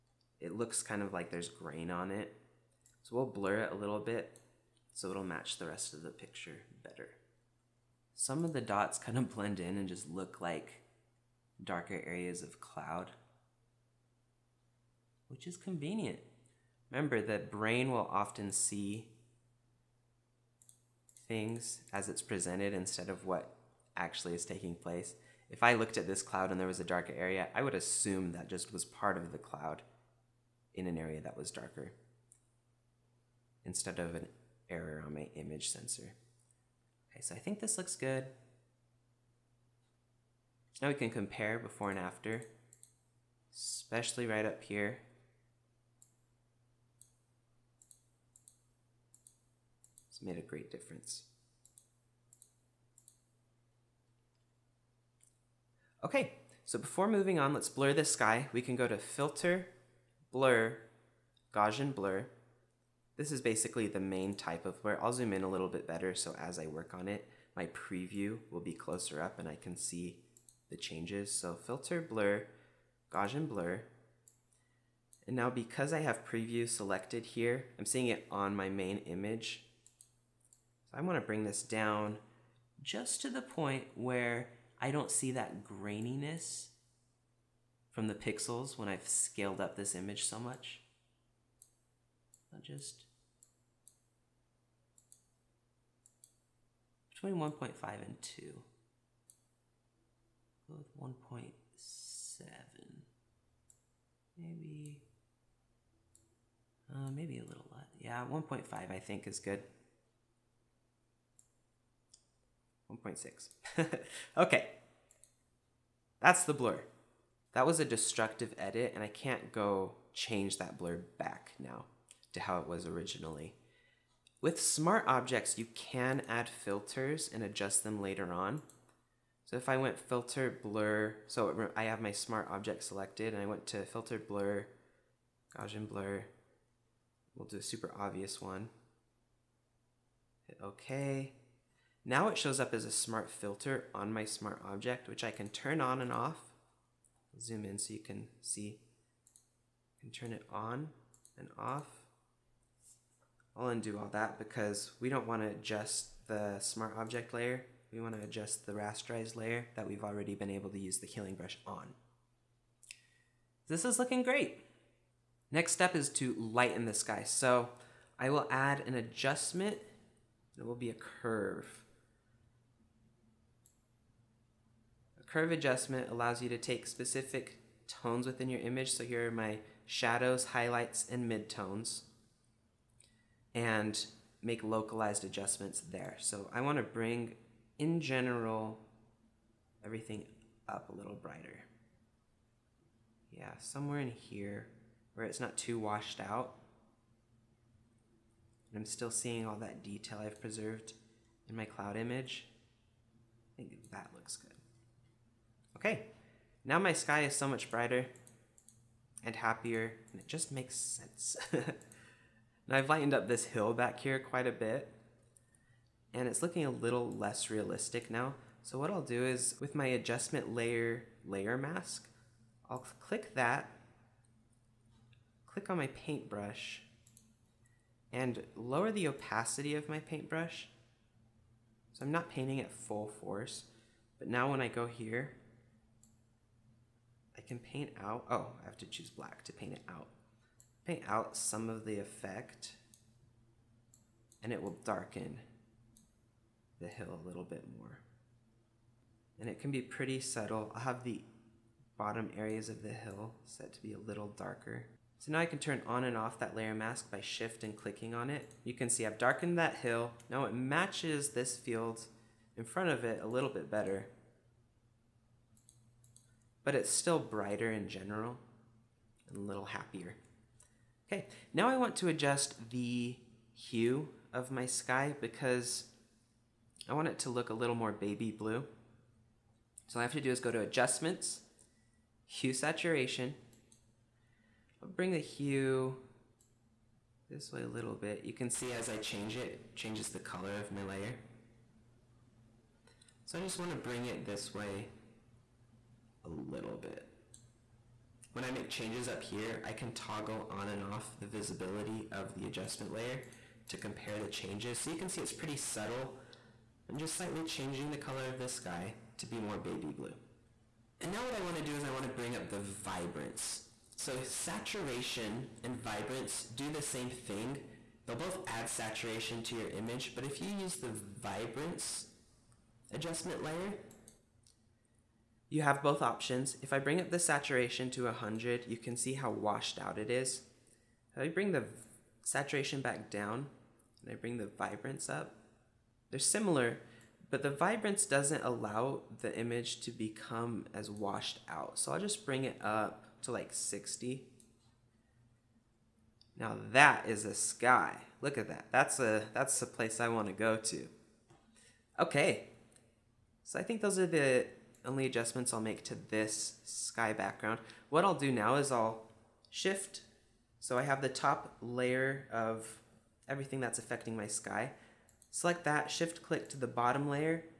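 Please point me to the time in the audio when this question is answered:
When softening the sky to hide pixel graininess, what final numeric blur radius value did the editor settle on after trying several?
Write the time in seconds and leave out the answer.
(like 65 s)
113 s.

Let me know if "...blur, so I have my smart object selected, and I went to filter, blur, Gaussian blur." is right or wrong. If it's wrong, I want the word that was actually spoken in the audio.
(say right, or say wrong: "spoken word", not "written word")
right.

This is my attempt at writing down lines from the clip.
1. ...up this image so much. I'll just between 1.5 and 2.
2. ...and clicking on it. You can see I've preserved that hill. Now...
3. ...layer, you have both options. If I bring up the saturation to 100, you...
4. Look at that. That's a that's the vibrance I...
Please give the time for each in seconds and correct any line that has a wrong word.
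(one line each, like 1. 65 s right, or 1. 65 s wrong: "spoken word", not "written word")
1. 89 s right
2. 257 s wrong: "darkened", not "preserved"
3. 323 s right
4. 348 s wrong: "place", not "vibrance".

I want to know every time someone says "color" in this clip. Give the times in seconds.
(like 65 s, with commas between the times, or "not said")
290 s, 307 s.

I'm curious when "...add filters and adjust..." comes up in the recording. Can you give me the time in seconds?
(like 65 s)
126 s.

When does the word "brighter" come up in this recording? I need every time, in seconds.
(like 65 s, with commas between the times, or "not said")
191 s, 207 s, 267 s.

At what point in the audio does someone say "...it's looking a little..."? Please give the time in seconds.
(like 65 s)
216 s.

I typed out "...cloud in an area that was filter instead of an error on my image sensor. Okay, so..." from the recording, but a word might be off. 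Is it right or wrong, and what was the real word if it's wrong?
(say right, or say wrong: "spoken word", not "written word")
wrong: "darker", not "filter".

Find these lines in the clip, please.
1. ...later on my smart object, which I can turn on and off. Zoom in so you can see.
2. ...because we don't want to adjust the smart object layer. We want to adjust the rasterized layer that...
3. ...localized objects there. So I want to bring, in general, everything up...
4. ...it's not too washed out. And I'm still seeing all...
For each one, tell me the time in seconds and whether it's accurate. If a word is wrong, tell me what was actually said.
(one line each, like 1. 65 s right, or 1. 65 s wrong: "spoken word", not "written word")
1. 143 s wrong: "filter", not "later"
2. 154 s right
3. 184 s wrong: "adjustments", not "objects"
4. 195 s right.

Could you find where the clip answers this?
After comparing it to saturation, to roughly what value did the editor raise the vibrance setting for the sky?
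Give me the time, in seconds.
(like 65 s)
343 s.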